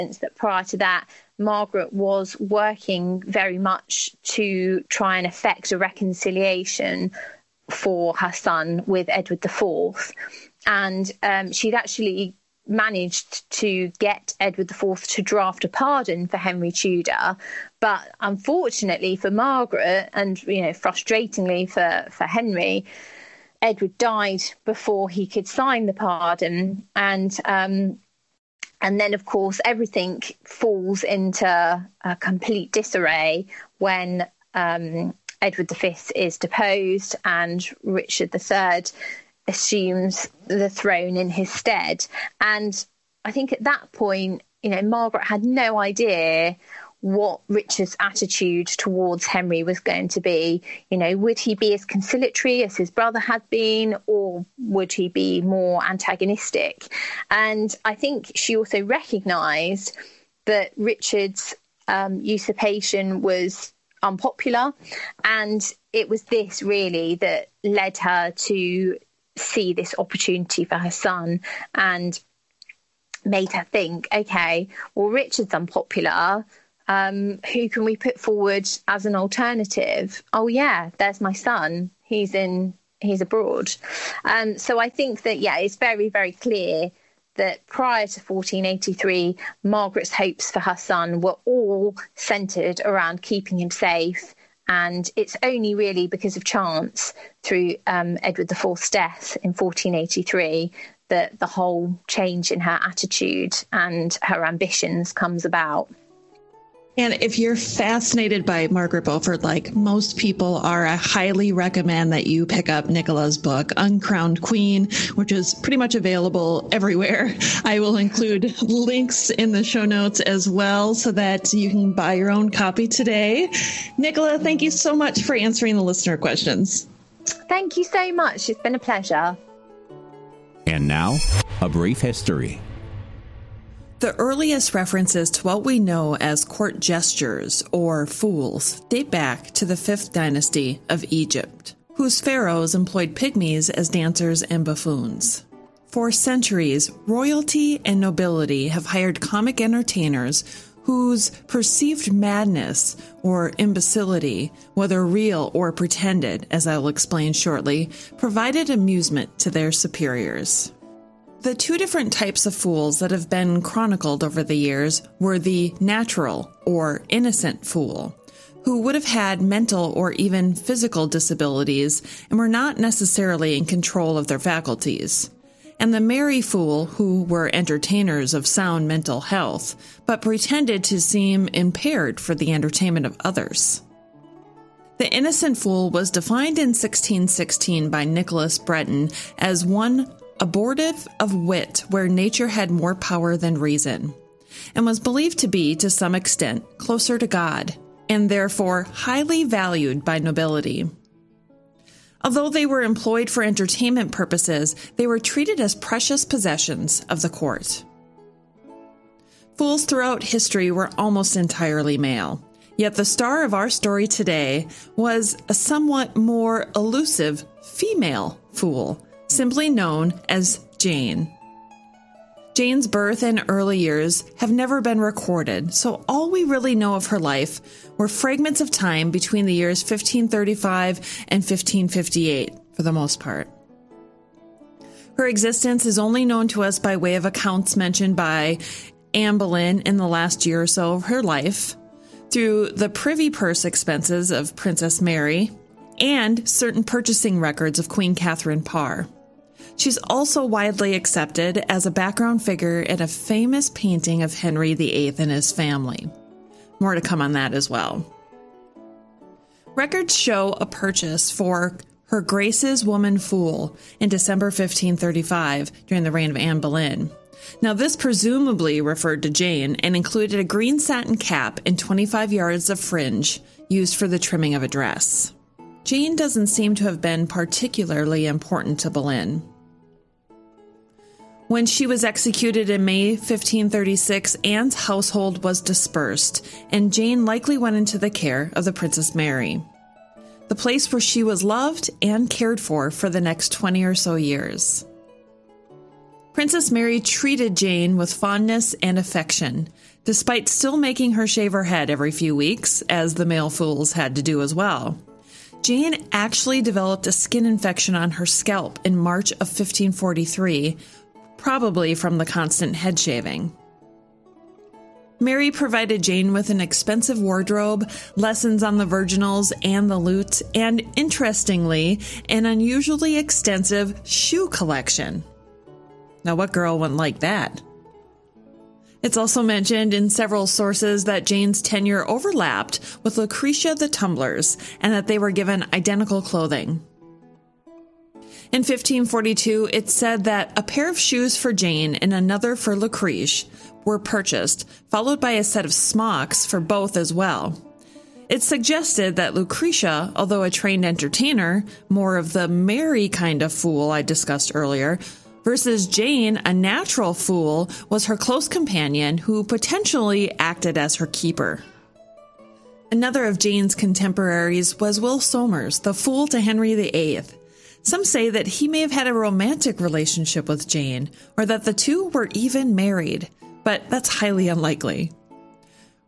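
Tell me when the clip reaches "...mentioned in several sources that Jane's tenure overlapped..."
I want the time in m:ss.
5:29.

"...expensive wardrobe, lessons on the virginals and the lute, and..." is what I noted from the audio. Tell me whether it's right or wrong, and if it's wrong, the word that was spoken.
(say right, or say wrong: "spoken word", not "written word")
right.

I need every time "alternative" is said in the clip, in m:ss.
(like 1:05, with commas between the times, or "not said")
1:19.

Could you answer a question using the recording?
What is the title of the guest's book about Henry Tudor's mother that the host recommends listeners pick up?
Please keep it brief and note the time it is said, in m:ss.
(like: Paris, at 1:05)
Uncrowned Queen, at 1:53.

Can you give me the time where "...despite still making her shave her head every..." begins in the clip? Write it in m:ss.
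5:00.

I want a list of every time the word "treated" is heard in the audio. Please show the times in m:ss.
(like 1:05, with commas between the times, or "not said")
3:25, 4:56.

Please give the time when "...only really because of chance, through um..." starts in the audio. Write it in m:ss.
1:35.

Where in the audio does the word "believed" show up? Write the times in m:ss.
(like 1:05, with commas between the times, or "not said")
3:14.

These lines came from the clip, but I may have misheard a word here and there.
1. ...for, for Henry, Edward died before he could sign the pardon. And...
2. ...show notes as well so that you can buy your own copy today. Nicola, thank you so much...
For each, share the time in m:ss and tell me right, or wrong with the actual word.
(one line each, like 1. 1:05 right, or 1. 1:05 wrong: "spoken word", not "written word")
1. 0:21 right
2. 1:59 right.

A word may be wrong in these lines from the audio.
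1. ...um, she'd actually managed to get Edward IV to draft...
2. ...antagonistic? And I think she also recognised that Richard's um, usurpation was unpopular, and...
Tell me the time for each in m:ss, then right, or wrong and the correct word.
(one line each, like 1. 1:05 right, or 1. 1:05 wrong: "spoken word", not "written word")
1. 0:11 right
2. 0:55 right.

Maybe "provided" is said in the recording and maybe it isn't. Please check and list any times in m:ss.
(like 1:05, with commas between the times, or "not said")
2:38, 5:15.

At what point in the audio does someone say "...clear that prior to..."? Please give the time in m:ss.
1:26.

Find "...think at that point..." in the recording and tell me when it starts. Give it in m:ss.
0:43.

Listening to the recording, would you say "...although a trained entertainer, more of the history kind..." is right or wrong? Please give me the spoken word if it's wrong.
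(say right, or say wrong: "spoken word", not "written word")
wrong: "merry", not "history".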